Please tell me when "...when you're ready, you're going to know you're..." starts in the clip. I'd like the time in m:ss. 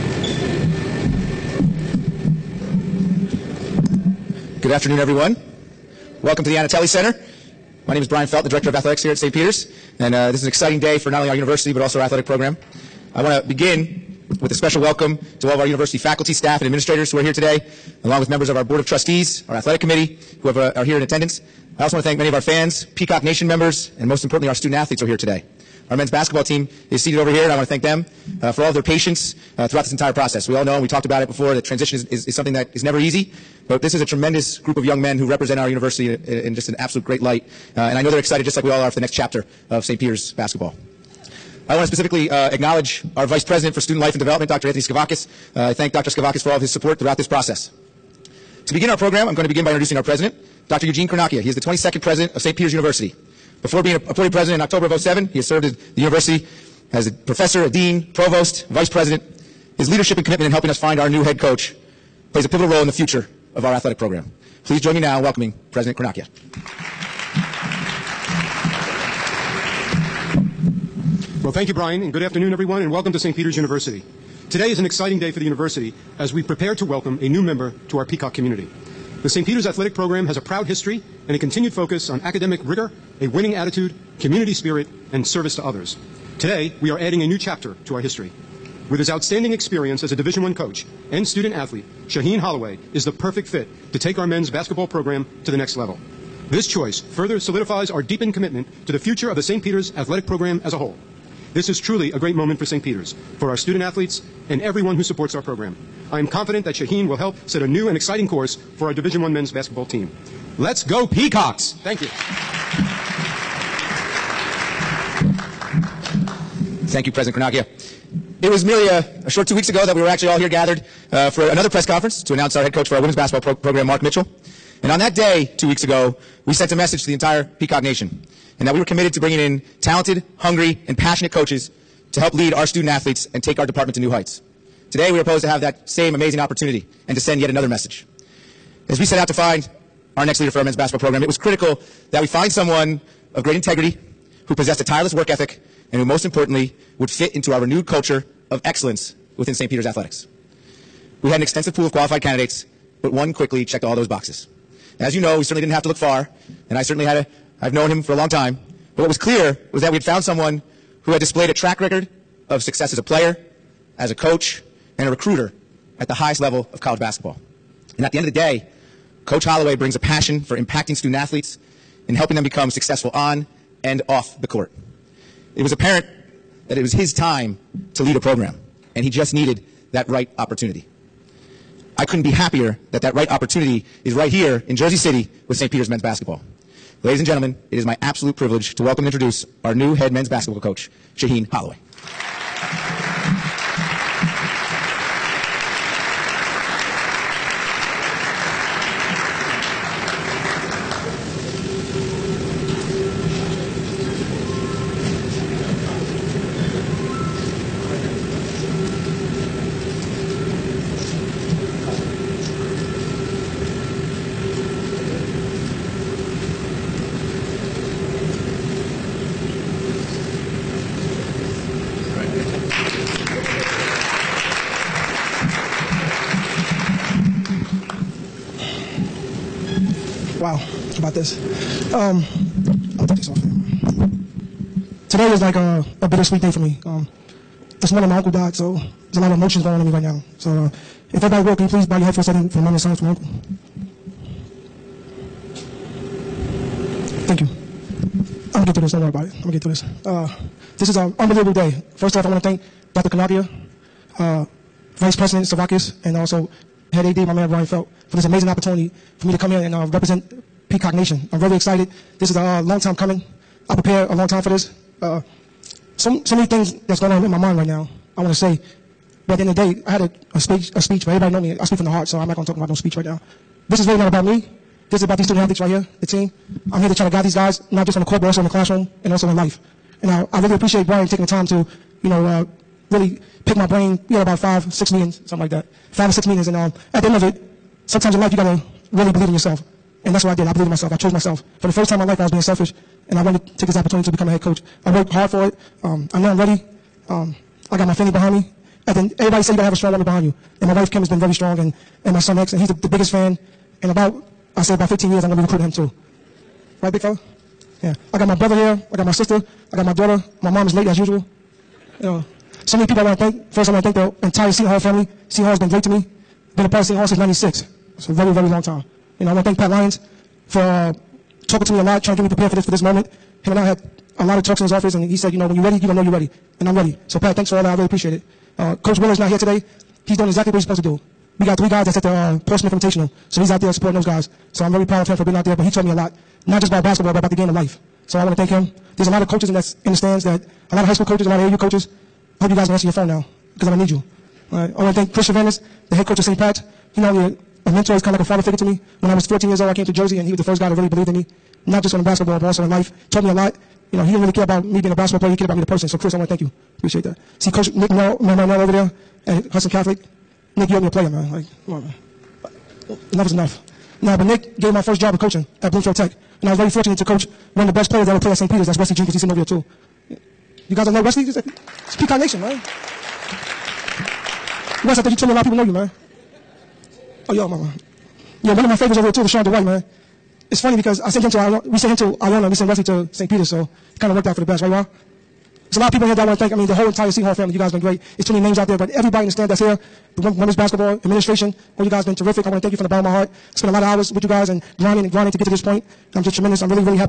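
5:25.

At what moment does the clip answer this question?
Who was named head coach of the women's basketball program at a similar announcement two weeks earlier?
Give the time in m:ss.
2:03.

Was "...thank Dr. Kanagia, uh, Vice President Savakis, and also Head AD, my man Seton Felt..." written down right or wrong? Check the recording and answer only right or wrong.
wrong.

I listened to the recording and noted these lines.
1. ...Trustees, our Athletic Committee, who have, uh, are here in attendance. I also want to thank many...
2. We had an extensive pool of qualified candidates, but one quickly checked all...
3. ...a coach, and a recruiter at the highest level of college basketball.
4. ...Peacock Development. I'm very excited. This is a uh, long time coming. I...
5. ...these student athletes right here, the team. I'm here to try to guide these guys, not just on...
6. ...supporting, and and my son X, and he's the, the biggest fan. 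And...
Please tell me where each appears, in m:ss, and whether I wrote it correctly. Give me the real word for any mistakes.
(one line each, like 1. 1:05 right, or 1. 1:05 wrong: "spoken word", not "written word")
1. 0:18 right
2. 2:31 right
3. 2:44 right
4. 4:20 wrong: "Nation", not "Development"
5. 4:35 right
6. 5:01 wrong: "strong", not "supporting".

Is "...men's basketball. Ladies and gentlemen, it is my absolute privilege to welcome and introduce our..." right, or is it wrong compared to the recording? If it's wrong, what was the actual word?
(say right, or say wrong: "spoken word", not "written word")
right.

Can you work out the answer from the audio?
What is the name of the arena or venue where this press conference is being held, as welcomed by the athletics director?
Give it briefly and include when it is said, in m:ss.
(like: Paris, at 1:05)
Yanitelli Center, at 0:06.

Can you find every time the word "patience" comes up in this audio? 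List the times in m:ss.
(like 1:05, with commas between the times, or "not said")
0:28.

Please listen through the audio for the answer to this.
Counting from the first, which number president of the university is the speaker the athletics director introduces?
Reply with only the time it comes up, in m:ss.
0:51.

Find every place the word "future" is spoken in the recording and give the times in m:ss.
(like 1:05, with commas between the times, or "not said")
1:02, 1:38.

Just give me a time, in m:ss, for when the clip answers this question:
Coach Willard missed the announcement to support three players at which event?
5:32.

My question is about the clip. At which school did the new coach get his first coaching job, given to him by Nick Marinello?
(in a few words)
Bloomfield Tech.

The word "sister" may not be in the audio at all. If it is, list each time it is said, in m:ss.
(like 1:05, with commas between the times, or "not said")
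5:09.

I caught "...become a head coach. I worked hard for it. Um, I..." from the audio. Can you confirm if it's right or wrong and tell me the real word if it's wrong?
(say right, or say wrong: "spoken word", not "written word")
right.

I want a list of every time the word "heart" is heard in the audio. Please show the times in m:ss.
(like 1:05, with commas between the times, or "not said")
4:31, 6:33.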